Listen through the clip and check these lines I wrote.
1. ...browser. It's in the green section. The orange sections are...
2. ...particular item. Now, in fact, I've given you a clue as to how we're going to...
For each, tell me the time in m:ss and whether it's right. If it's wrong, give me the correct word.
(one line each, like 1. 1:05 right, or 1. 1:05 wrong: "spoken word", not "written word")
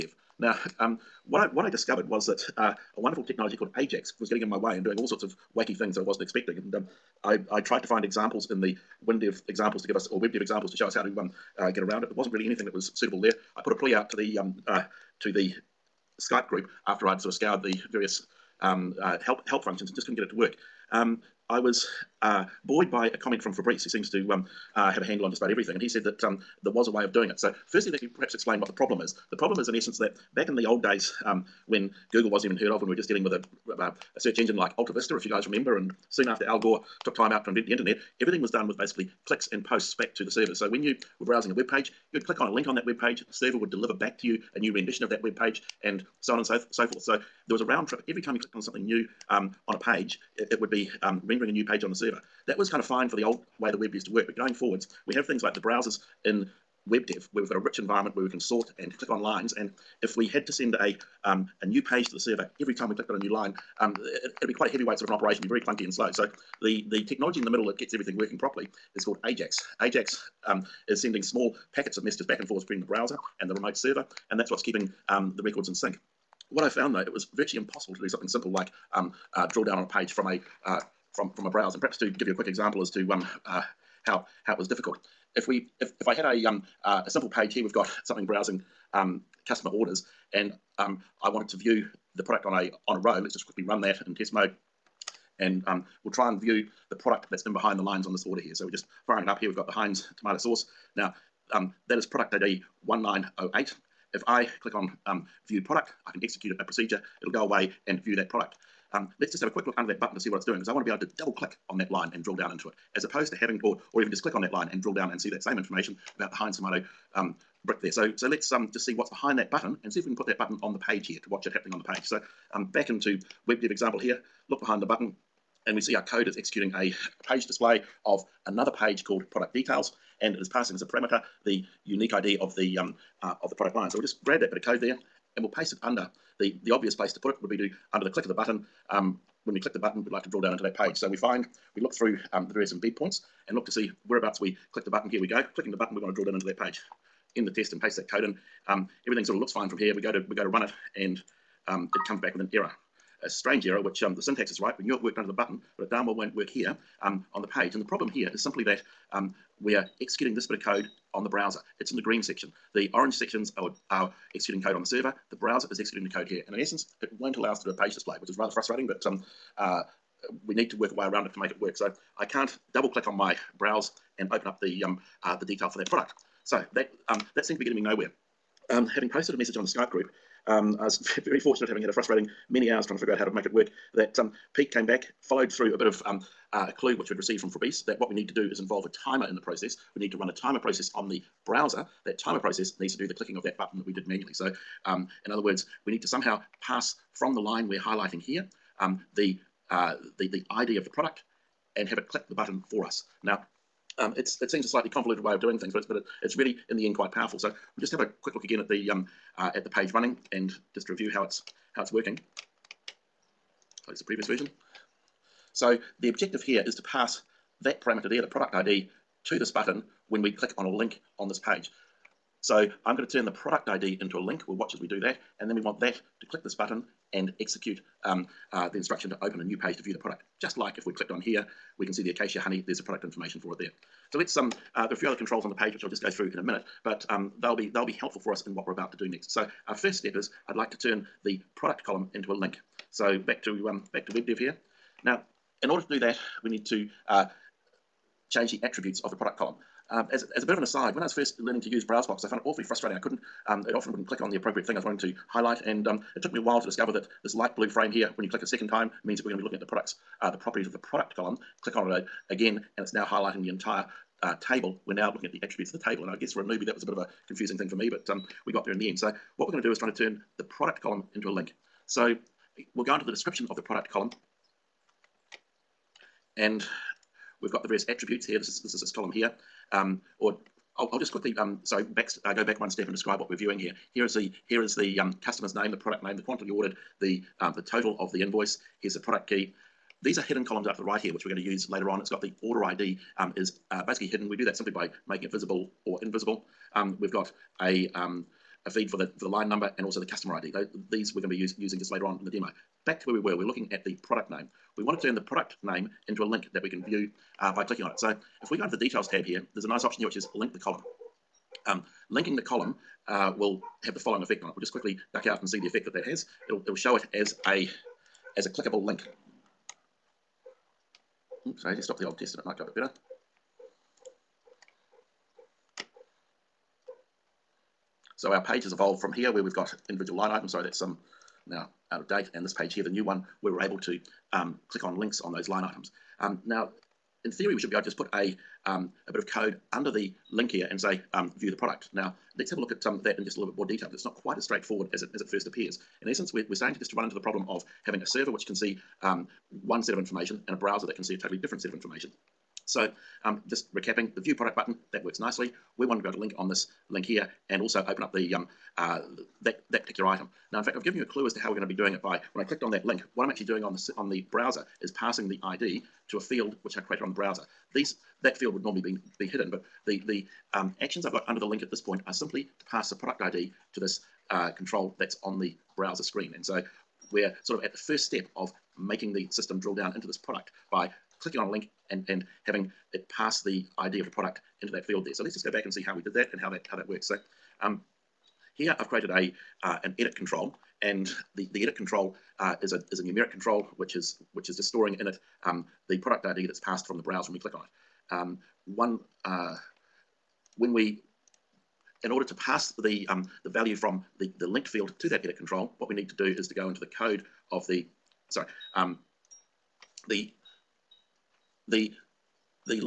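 1. 2:41 right
2. 5:59 right.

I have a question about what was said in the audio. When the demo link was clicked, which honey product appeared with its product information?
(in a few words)
acacia honey.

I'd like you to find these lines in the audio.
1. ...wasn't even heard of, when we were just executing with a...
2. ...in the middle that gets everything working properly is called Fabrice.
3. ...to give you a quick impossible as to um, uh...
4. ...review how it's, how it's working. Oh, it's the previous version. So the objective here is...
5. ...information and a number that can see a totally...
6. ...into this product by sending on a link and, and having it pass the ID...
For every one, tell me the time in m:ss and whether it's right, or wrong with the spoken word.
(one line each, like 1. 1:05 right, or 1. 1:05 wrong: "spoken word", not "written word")
1. 0:32 wrong: "dealing", not "executing"
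2. 1:07 wrong: "AJAX", not "Fabrice"
3. 1:21 wrong: "example", not "impossible"
4. 3:30 right
5. 5:49 wrong: "browser", not "number"
6. 6:19 wrong: "clicking", not "sending".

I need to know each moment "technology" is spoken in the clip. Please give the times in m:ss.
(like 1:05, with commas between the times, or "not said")
0:03, 1:07.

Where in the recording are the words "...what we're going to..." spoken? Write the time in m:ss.
4:29.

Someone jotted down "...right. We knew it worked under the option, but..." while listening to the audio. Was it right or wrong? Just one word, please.
wrong.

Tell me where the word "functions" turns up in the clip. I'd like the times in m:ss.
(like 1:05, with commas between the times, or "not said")
0:19.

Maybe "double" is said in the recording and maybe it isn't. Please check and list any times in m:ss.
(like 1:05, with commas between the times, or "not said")
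1:51, 2:52.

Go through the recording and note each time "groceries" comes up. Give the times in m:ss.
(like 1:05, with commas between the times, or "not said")
not said.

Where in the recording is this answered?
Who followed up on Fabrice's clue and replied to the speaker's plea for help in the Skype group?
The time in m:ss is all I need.
3:04.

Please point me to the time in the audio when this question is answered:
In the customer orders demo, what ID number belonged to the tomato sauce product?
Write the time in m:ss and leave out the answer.
1:42.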